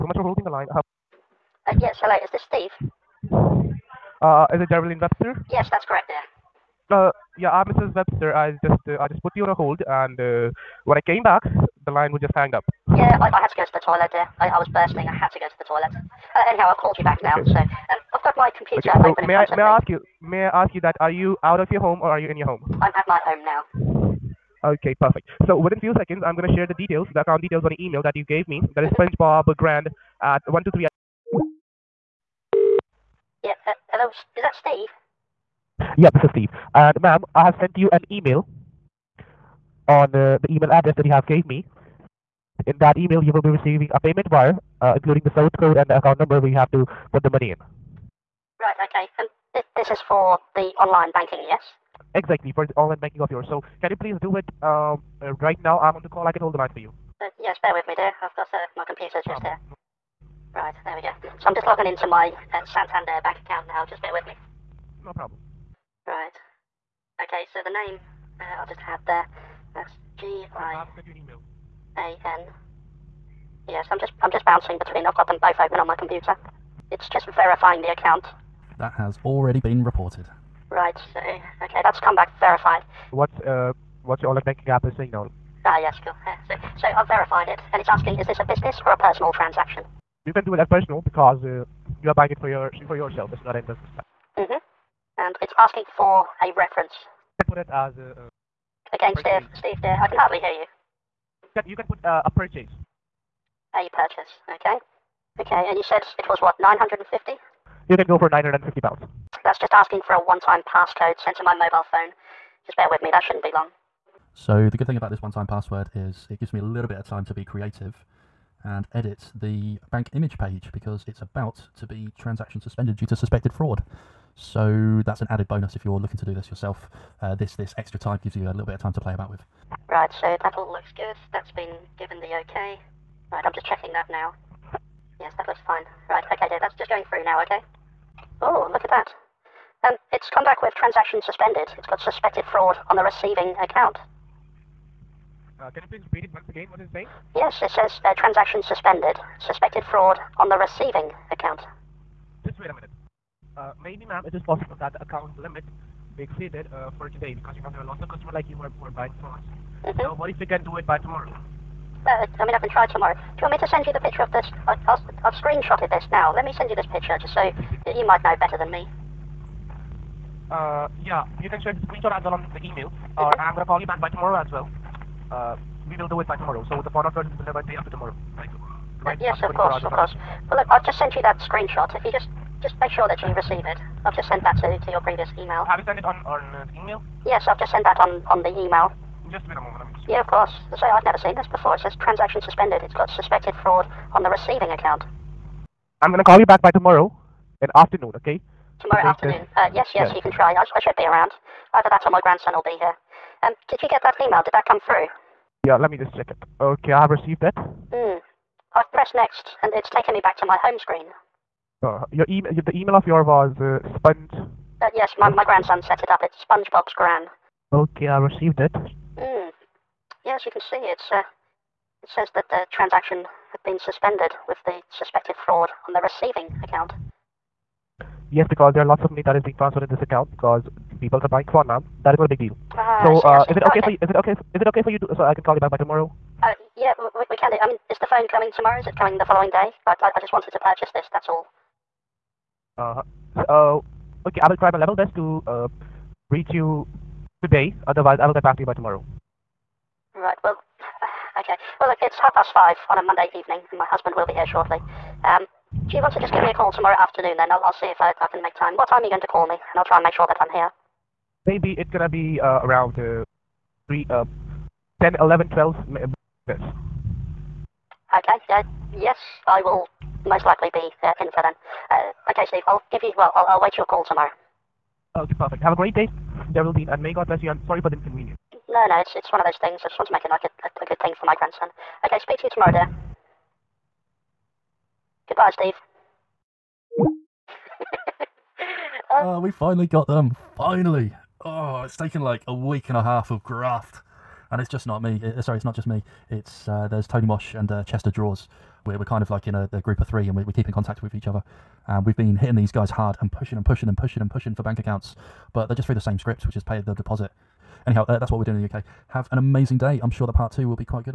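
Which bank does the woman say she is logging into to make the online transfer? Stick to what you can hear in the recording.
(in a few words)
Santander.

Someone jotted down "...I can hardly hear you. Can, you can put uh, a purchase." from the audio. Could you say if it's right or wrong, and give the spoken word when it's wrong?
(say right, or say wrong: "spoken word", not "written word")
right.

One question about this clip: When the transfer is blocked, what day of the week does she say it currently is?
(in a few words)
Monday.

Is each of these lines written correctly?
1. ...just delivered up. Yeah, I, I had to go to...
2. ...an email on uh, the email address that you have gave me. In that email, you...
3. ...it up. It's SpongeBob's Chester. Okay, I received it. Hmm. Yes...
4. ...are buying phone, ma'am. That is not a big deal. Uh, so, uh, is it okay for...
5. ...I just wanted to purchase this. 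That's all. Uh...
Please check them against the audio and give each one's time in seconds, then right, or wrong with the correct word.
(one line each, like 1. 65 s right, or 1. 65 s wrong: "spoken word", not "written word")
1. 12 s wrong: "hanged", not "delivered"
2. 37 s right
3. 216 s wrong: "Gran", not "Chester"
4. 231 s right
5. 240 s right.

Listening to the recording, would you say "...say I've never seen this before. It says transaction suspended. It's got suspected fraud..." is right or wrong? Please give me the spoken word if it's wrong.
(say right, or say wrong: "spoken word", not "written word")
right.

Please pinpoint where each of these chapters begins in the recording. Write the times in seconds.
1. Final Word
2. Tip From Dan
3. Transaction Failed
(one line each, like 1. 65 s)
1. 286 s
2. 113 s
3. 130 s.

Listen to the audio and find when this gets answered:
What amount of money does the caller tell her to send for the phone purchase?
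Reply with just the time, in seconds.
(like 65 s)
108 s.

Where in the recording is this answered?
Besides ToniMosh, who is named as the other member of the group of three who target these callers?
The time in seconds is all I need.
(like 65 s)
297 s.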